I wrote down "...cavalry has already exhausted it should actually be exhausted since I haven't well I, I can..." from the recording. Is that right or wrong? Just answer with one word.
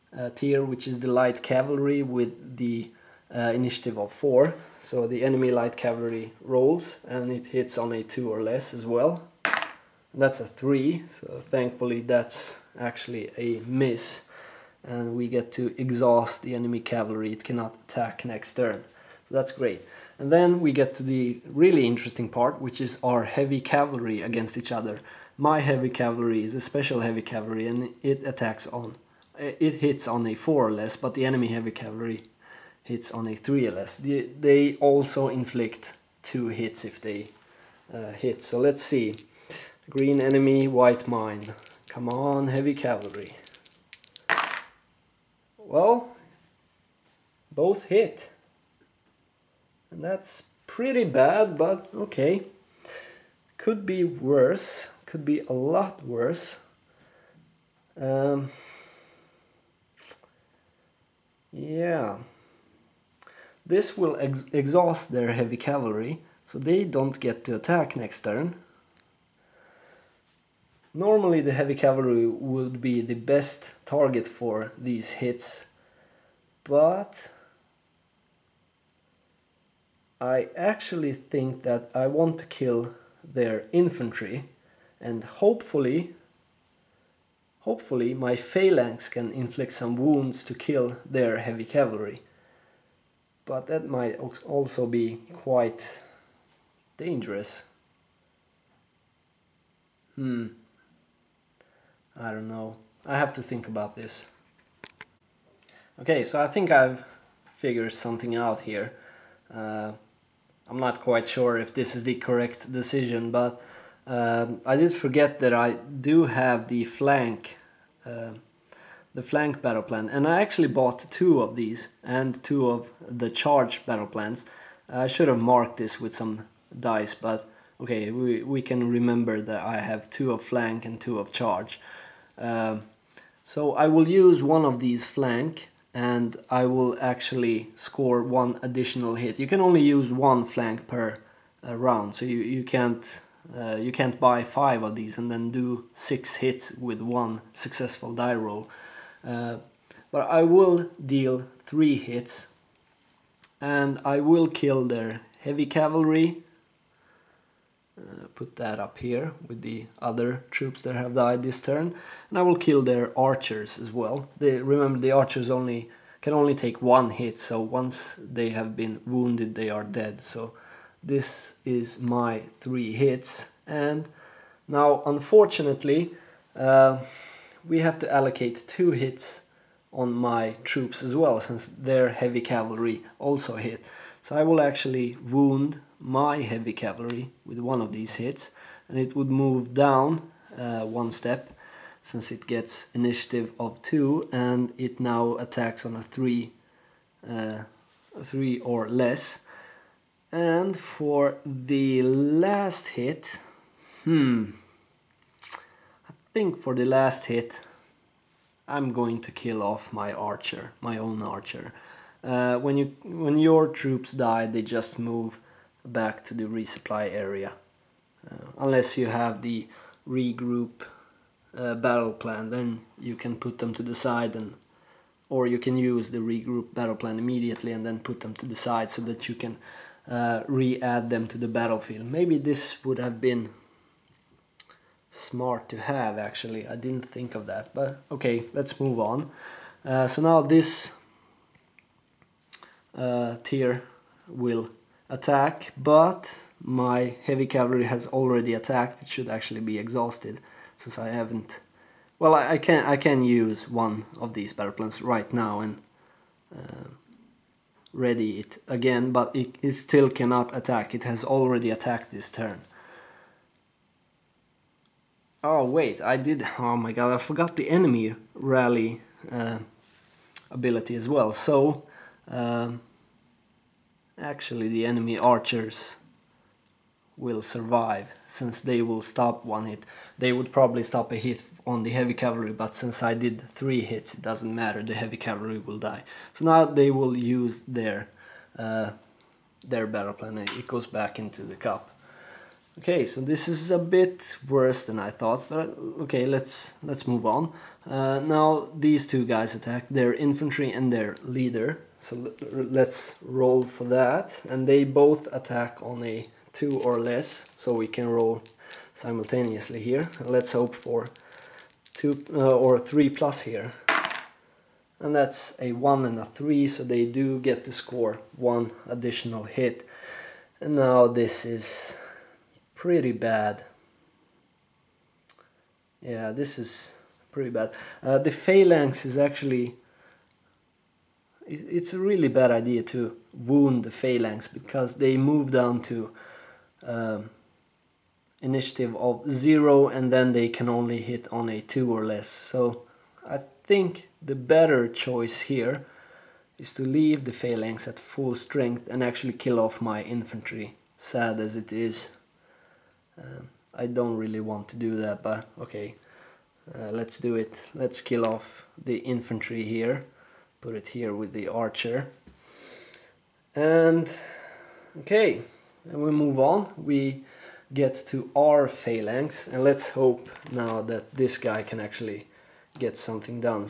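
wrong.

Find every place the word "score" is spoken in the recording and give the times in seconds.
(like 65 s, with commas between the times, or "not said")
137 s, 317 s.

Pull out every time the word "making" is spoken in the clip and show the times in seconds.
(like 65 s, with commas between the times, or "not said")
not said.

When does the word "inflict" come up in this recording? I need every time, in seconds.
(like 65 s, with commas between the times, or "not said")
35 s, 89 s.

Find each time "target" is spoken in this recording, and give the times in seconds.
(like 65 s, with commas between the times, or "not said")
73 s.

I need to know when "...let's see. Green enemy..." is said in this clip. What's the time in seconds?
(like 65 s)
38 s.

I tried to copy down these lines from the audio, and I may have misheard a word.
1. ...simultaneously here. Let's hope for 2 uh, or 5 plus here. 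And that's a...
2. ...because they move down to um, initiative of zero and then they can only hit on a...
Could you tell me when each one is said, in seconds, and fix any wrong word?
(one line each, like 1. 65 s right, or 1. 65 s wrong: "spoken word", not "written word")
1. 308 s wrong: "3", not "5"
2. 334 s right.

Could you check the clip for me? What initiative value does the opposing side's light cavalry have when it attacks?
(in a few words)
4.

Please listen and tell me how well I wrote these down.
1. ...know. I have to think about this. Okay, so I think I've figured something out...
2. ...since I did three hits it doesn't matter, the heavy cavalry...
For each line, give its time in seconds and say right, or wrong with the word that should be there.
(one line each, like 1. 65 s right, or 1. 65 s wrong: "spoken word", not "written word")
1. 102 s right
2. 282 s right.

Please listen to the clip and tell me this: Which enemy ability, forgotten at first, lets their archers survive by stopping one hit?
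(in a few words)
Rally.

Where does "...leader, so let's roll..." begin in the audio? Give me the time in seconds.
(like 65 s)
301 s.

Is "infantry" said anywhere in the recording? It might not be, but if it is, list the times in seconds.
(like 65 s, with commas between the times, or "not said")
83 s, 300 s, 350 s, 358 s.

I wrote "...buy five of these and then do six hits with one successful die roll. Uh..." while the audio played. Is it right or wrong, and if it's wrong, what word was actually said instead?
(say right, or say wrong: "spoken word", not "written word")
right.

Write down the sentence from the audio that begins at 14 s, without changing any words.
And we get to exhaust the enemy cavalry, it cannot attack next turn.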